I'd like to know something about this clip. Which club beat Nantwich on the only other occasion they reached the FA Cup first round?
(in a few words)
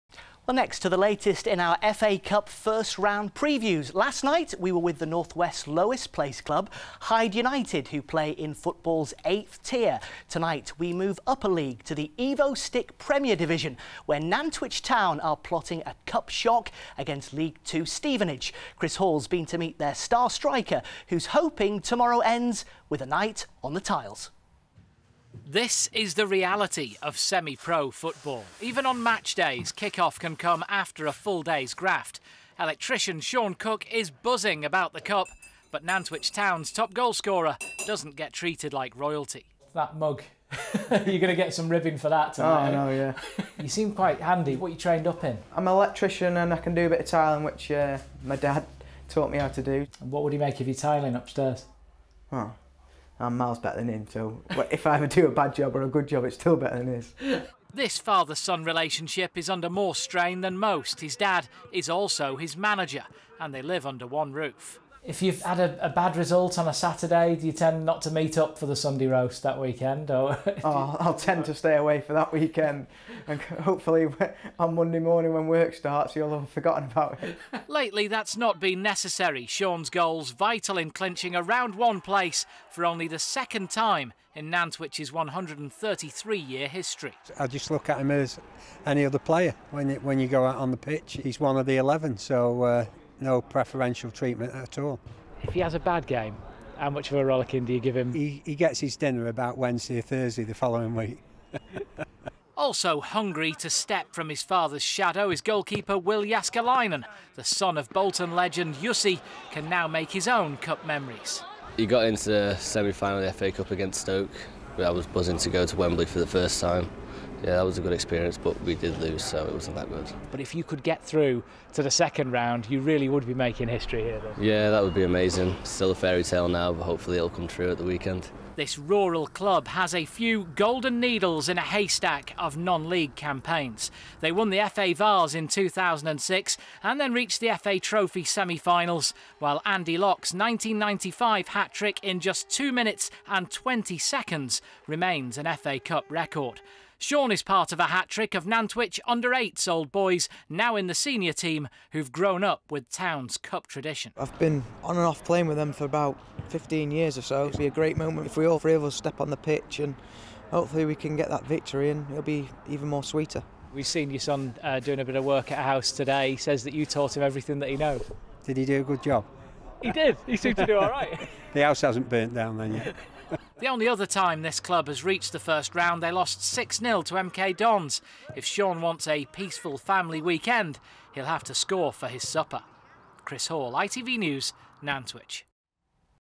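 MK Dons.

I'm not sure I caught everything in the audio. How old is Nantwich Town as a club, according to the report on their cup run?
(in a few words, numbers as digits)
133 years.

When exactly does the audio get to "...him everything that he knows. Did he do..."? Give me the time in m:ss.
2:47.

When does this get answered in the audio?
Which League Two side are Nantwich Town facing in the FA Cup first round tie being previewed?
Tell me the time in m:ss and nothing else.
0:17.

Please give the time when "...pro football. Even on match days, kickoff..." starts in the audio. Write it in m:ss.
0:27.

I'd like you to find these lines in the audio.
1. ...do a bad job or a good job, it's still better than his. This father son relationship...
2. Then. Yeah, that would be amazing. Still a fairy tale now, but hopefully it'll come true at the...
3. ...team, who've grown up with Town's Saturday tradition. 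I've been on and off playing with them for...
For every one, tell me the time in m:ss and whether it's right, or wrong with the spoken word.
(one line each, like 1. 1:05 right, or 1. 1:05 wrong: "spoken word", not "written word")
1. 0:55 right
2. 2:04 right
3. 2:31 wrong: "Cup", not "Saturday".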